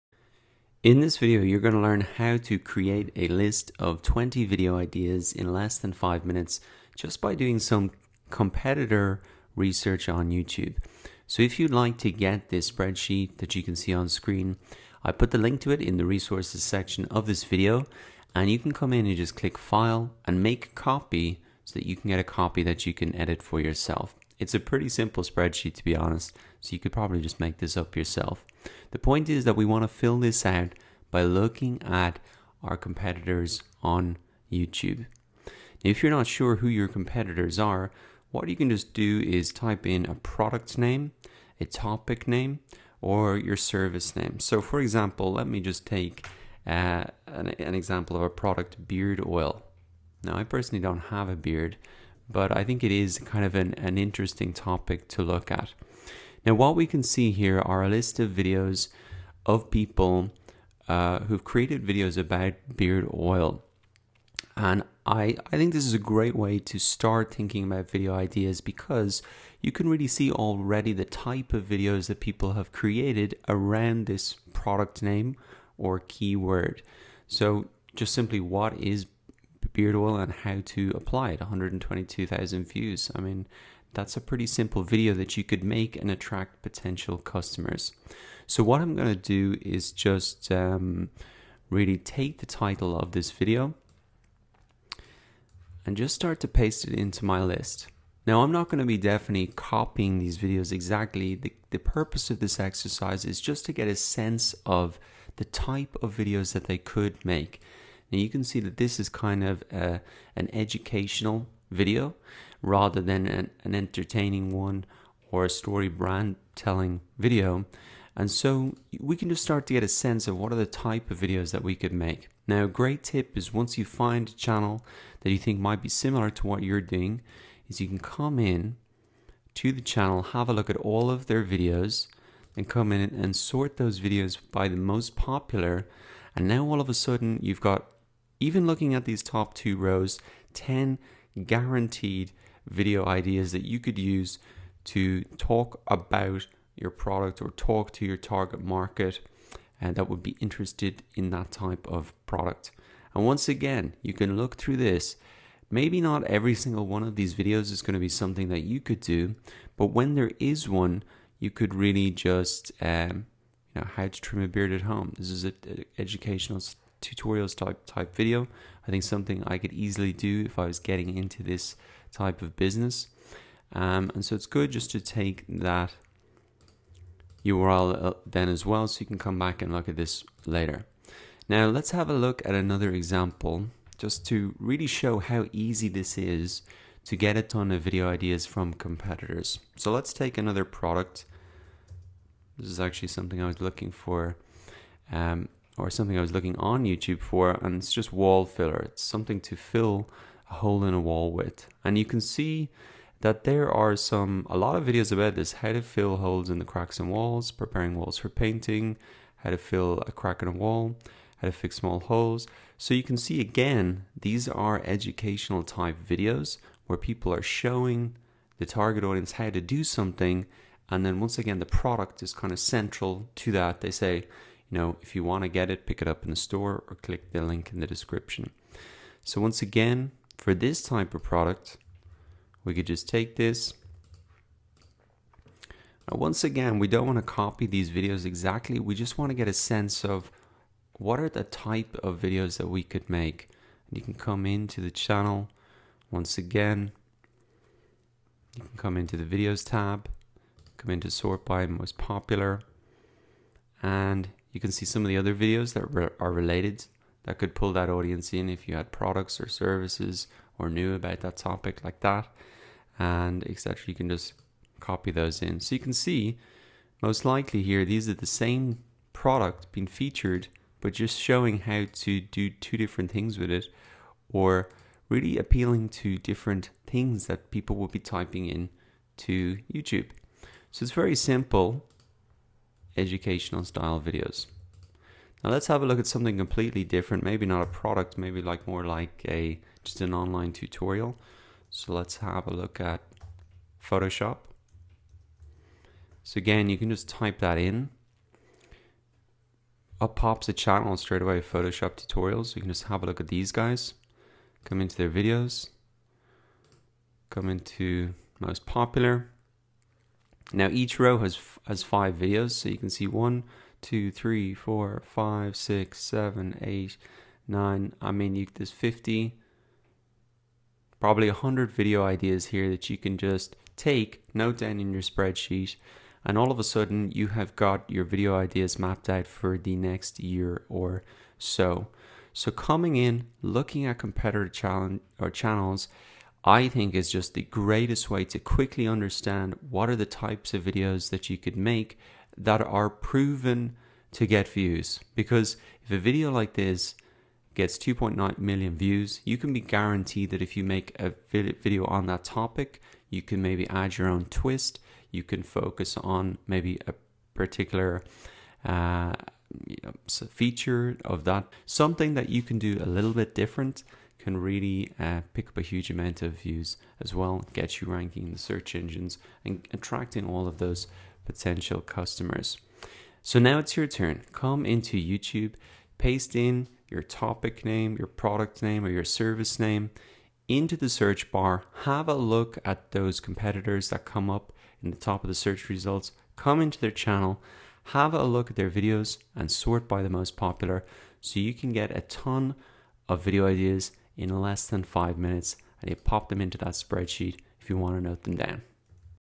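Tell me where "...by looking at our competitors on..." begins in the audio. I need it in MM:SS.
00:31.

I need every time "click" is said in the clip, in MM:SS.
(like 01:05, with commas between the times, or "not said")
00:19, 03:46.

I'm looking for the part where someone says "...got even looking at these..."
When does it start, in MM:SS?
02:17.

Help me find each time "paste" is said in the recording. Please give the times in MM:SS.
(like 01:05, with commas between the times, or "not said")
01:36, 06:15.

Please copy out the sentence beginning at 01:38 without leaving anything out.
Now I'm not going to be definitely copying these videos exactly.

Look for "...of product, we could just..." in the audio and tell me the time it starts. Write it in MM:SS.
03:51.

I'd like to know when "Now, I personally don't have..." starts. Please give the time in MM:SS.
00:50.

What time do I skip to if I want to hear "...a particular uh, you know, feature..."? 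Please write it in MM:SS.
05:56.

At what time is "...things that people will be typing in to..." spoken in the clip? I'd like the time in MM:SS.
04:36.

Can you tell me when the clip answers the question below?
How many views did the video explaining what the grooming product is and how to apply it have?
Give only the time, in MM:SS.
01:21.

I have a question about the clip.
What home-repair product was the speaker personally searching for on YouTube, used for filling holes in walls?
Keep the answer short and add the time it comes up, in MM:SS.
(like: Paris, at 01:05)
wall filler, at 03:18.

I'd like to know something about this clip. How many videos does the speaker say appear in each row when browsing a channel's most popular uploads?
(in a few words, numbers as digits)
5.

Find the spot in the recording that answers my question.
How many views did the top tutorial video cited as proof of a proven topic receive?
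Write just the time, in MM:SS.
05:47.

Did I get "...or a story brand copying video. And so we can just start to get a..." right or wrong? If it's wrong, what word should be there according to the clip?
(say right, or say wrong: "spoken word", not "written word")
wrong: "telling", not "copying".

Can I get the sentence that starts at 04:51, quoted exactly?
So let's have a look at Photoshop.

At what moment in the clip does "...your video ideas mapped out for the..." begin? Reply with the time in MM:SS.
05:27.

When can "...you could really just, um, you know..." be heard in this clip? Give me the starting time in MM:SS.
02:41.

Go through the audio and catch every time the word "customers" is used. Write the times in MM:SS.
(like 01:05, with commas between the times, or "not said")
01:27, 06:11.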